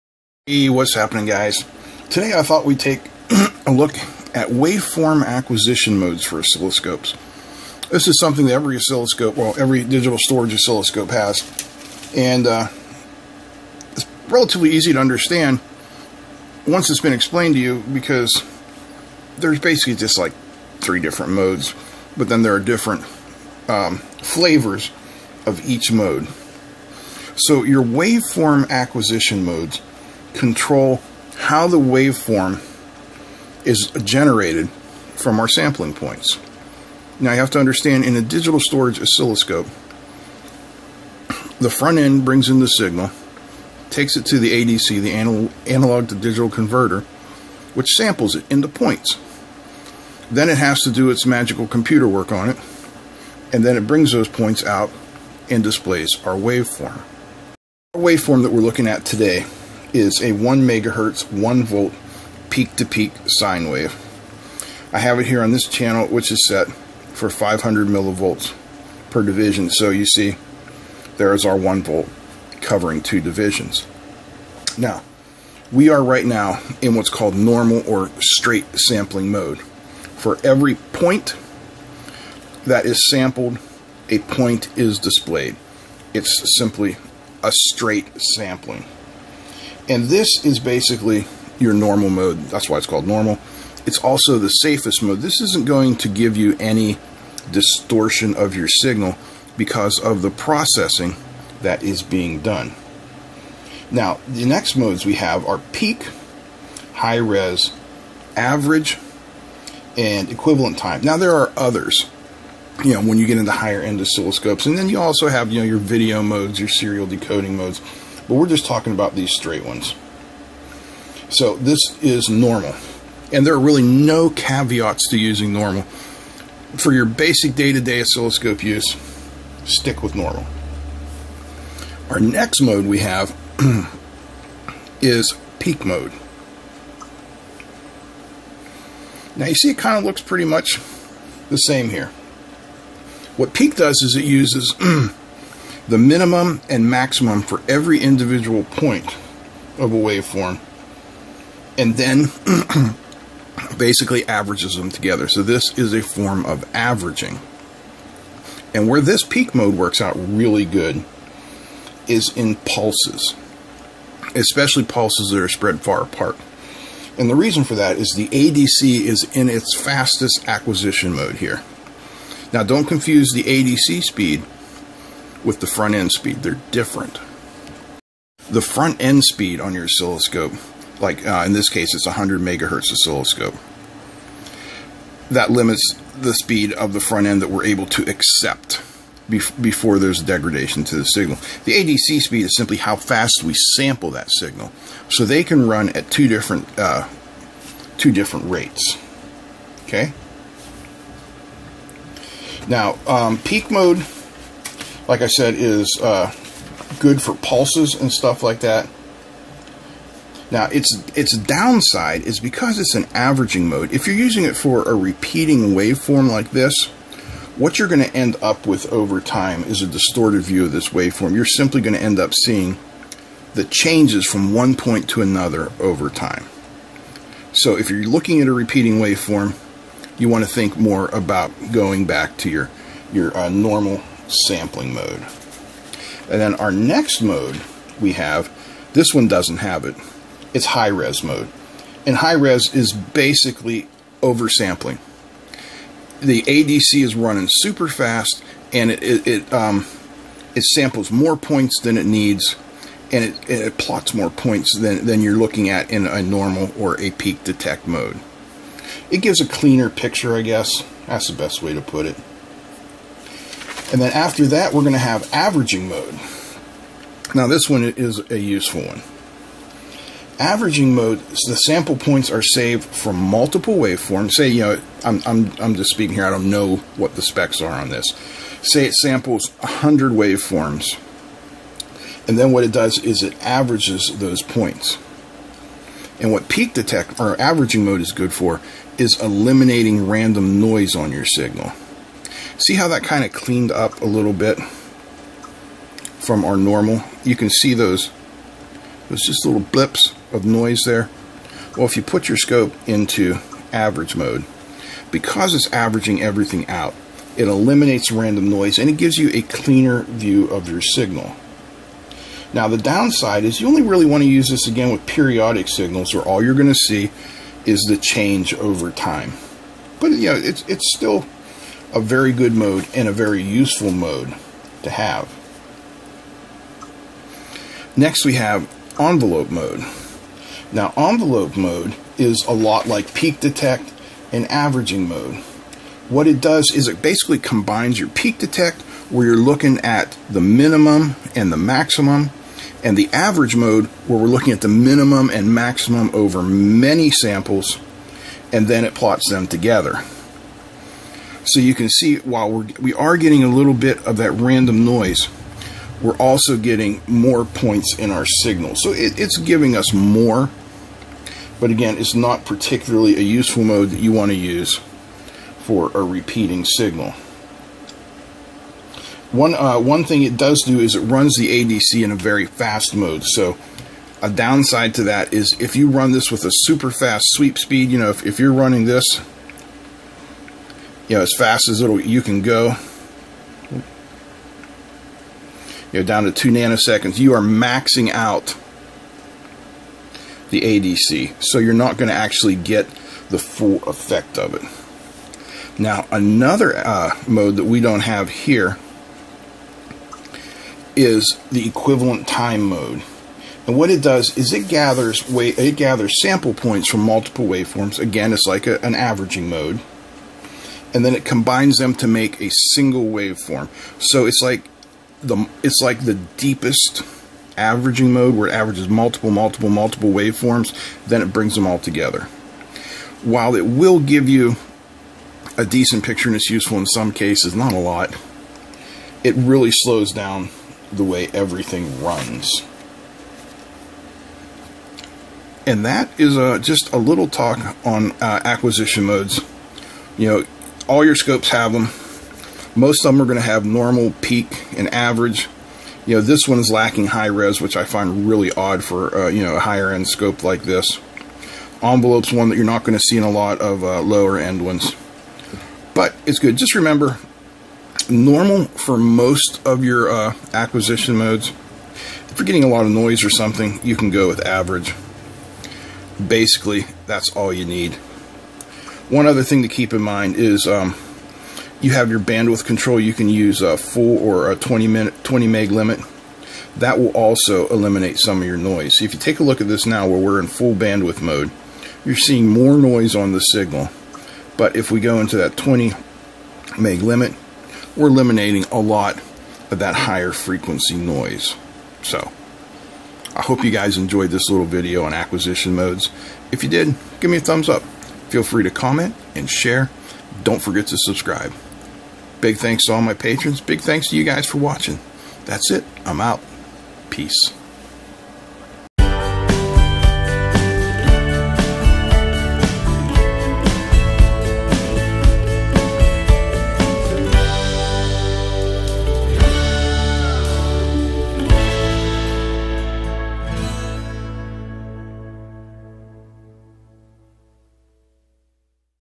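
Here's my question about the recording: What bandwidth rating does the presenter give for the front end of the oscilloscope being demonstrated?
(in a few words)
100 megahertz.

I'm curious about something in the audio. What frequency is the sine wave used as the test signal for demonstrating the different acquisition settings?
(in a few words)
1 megahertz.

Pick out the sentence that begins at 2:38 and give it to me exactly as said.
And where this peak mode works out really good is in pulses, especially pulses that are spread far apart.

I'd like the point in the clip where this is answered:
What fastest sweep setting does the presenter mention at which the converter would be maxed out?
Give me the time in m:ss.
6:26.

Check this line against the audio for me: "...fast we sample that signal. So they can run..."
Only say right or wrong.
right.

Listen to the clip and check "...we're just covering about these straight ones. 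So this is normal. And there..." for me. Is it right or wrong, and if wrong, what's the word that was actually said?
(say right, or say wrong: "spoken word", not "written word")
wrong: "talking", not "covering".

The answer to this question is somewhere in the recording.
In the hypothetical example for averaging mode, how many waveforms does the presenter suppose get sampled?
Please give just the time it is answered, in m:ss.
4:39.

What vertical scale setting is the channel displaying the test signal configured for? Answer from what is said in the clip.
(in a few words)
500 millivolts per division.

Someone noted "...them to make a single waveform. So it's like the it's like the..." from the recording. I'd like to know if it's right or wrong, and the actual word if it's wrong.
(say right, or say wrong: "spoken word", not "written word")
right.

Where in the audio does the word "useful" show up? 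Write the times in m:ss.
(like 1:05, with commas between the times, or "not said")
4:28, 5:23, 6:03, 7:06.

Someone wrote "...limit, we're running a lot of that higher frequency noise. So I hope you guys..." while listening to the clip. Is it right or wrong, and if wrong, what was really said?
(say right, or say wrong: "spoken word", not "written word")
wrong: "eliminating", not "running".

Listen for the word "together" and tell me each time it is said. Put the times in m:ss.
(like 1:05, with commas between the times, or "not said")
2:34, 5:49, 7:01.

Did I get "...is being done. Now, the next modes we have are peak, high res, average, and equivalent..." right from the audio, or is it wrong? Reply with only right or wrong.
right.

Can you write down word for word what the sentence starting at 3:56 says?
And then our next mode we have, this one doesn't have it, it's high res mode.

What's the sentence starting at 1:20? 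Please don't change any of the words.
For every point that is sampled, a point is displayed.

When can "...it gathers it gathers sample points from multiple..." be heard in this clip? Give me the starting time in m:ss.
6:44.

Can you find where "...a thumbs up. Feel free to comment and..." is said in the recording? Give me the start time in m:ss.
8:17.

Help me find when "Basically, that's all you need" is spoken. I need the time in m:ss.
7:46.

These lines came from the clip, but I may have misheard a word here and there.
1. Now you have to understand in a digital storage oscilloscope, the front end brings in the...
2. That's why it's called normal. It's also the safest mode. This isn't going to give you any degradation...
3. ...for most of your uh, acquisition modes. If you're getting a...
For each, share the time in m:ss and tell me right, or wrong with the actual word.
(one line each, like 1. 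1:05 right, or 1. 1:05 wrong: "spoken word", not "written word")
1. 0:37 right
2. 1:32 wrong: "distortion", not "degradation"
3. 7:38 right.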